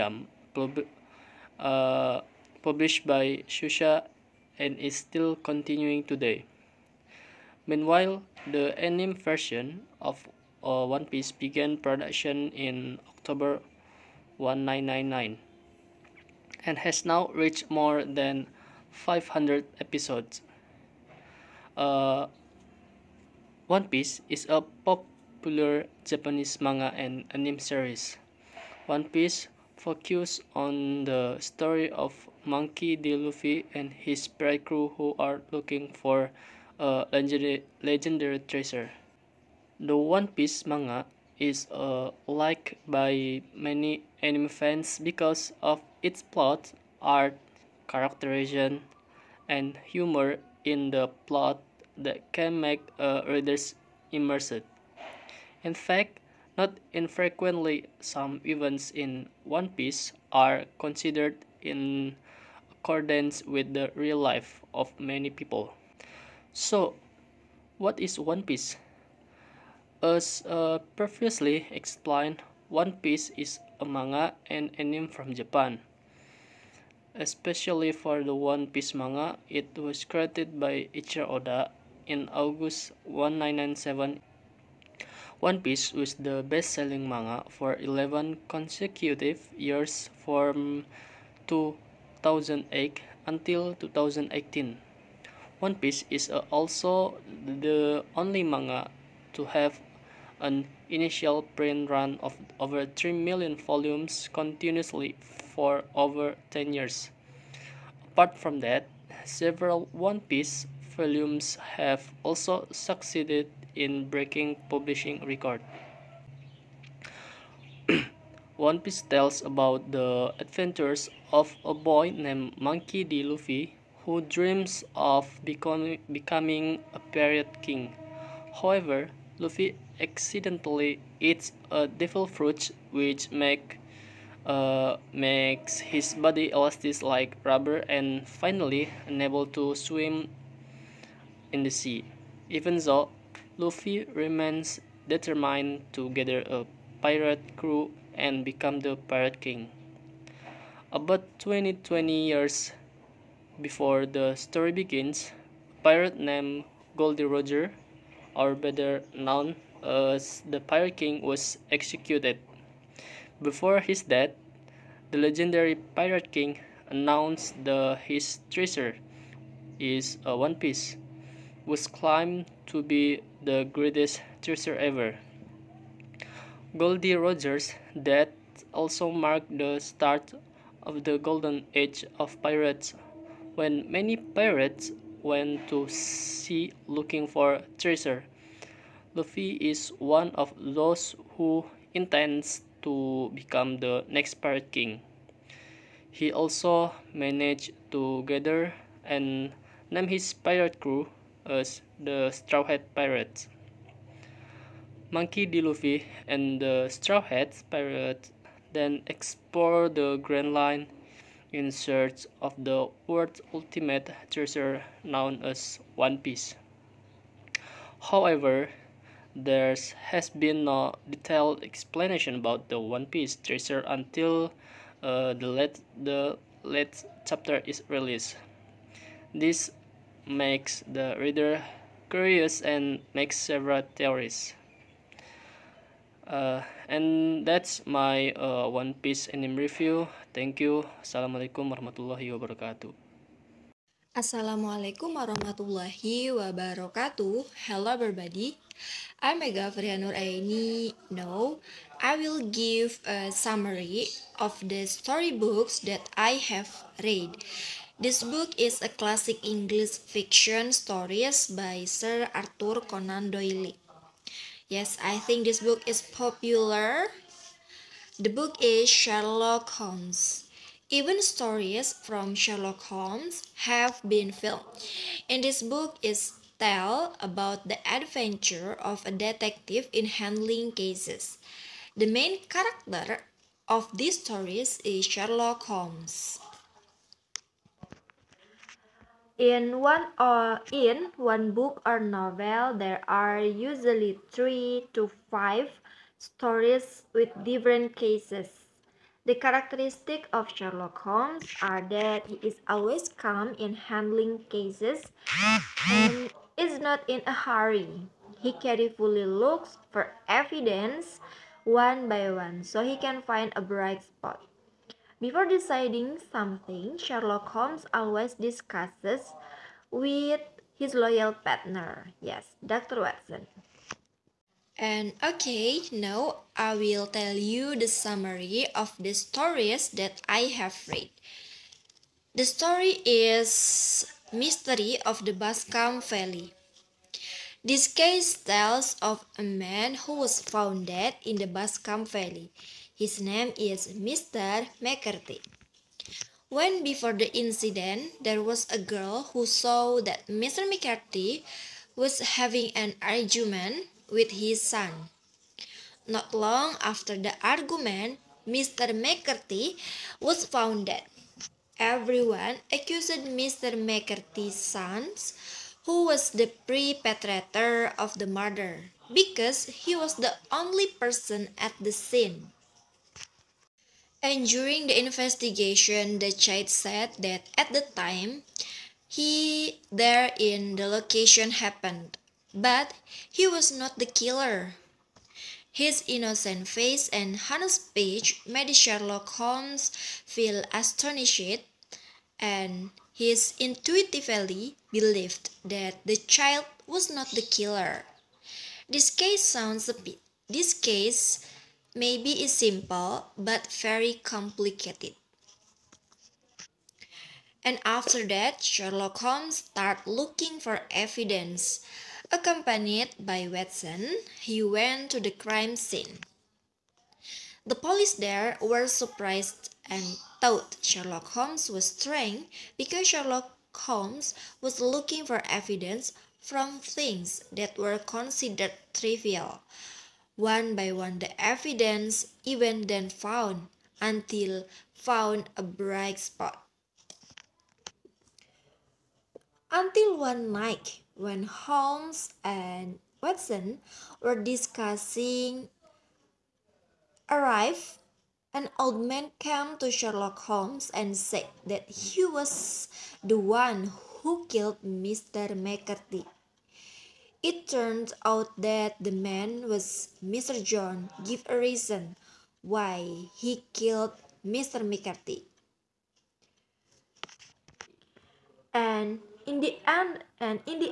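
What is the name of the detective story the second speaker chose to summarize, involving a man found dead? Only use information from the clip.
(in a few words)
Mystery of the Boscombe Valley.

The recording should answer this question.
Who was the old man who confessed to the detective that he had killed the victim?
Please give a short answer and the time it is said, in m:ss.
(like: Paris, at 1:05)
Mr. John, at 7:40.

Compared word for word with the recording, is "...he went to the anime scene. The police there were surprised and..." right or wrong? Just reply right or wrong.
wrong.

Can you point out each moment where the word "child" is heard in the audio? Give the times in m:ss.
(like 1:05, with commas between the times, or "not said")
6:16, 6:36.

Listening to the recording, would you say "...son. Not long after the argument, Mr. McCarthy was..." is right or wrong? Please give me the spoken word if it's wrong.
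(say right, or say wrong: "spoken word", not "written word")
right.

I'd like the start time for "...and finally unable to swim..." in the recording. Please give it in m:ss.
2:17.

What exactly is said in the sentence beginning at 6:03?
McCarthy's sons, who was the perpetrator of the murder, because he was the only person at the scene.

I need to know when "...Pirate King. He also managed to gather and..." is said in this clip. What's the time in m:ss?
3:14.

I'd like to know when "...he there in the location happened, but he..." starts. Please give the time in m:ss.
6:19.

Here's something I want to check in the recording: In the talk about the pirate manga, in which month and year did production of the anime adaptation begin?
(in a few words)
October 1999.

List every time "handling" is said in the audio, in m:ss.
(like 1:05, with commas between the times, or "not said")
4:40, 5:03.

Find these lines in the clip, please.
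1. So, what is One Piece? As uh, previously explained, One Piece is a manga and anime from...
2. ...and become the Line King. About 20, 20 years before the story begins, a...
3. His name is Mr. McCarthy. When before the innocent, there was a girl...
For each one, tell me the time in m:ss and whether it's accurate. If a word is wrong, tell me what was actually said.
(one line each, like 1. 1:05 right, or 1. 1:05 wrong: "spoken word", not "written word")
1. 1:06 right
2. 2:28 wrong: "Pirate", not "Line"
3. 5:42 wrong: "incident", not "innocent".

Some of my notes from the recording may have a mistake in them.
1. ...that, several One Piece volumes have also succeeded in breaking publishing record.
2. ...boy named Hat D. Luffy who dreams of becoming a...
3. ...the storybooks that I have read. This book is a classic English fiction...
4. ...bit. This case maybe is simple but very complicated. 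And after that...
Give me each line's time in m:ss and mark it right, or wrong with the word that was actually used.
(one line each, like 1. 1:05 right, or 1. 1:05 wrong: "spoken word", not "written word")
1. 1:48 right
2. 2:01 wrong: "Monkey", not "Hat"
3. 4:14 right
4. 6:39 right.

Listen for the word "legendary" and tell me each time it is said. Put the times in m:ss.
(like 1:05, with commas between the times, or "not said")
0:37, 2:45.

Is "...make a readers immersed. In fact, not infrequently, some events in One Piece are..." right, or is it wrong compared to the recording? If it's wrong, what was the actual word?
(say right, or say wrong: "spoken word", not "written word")
right.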